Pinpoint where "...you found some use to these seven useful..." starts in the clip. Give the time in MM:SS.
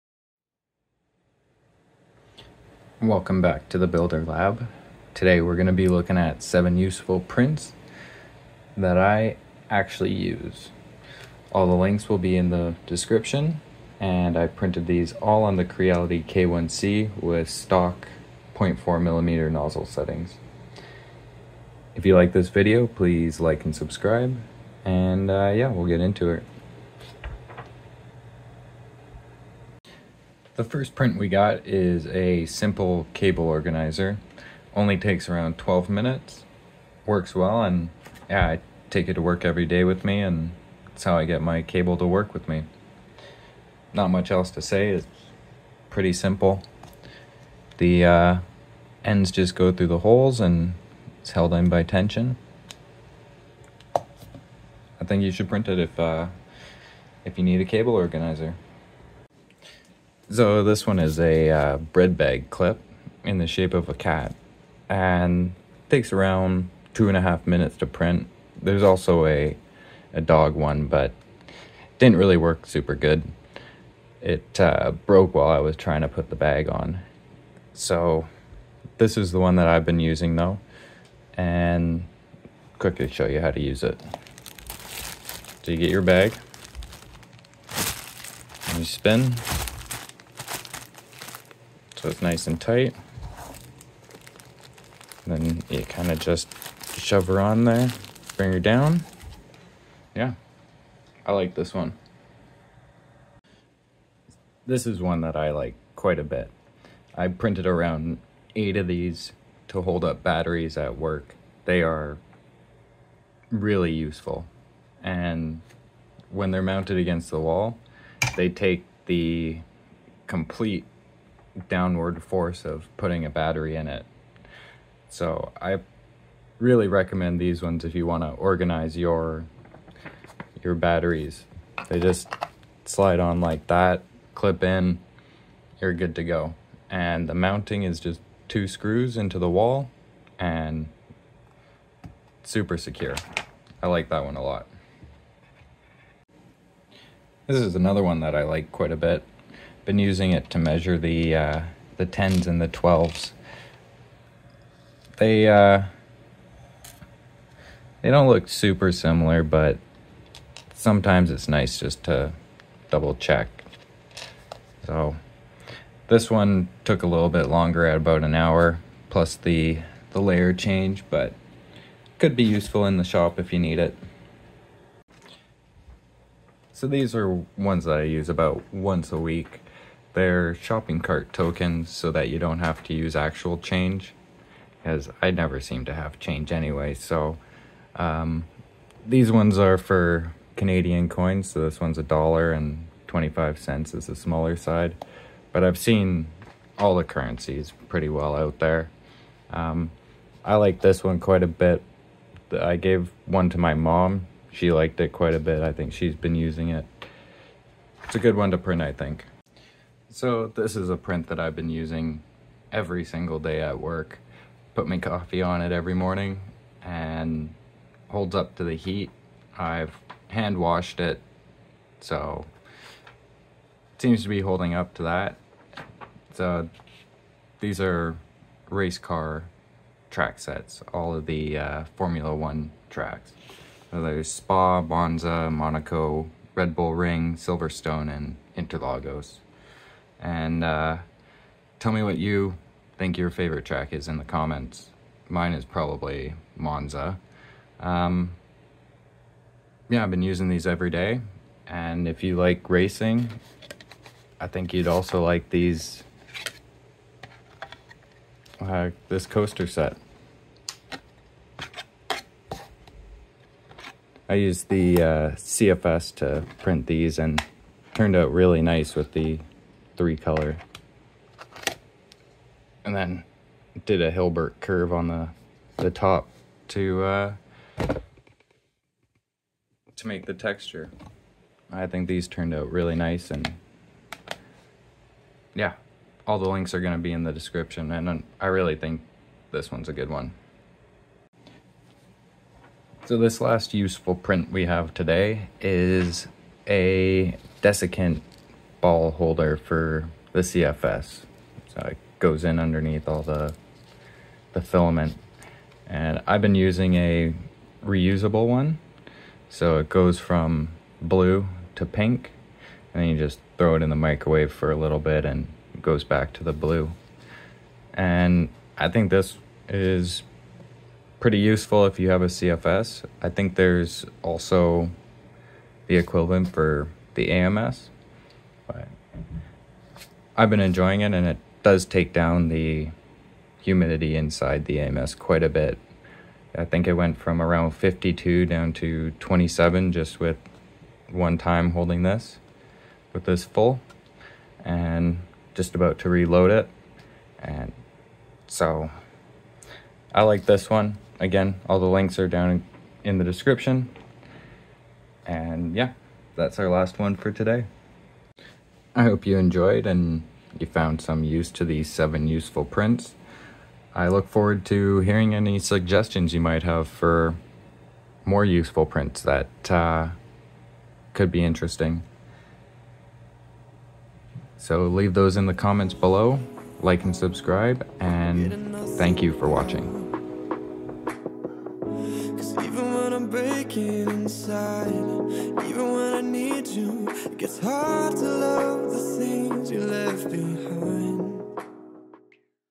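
06:00.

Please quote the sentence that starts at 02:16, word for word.
And the mounting is just two screws into the wall and super secure.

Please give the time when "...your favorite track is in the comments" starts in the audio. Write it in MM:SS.
04:03.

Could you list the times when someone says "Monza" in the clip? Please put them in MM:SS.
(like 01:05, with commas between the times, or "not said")
03:54, 04:06.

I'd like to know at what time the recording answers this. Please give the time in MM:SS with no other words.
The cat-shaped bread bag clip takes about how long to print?
01:06.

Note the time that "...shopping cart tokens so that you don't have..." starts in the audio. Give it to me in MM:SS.
03:00.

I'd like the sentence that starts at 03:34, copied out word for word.
Put my coffee on it every morning and holds up to the heat.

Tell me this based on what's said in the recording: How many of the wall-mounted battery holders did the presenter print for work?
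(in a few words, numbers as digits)
8.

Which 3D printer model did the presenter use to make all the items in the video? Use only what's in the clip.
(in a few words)
Creality K1C.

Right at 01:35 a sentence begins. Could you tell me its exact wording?
then you kind of just shove her on there, bring her down.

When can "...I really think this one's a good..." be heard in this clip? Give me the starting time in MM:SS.
04:48.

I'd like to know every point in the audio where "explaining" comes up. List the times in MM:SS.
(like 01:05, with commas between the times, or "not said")
not said.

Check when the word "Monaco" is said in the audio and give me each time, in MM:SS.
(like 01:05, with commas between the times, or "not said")
03:55.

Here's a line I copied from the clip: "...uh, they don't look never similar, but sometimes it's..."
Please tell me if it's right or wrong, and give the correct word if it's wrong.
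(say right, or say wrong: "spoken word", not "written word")
wrong: "super", not "never".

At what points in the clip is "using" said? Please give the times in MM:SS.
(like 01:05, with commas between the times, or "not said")
01:19, 02:29, 03:26, 03:31, 04:10, 05:06.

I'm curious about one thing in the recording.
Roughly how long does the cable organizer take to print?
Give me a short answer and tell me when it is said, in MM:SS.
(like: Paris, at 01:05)
12 minutes, at 00:35.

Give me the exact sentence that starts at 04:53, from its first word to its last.
So this last useful print we have today is a desiccant ball holder for the CFS.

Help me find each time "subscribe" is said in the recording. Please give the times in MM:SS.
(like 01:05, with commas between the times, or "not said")
00:23, 06:17.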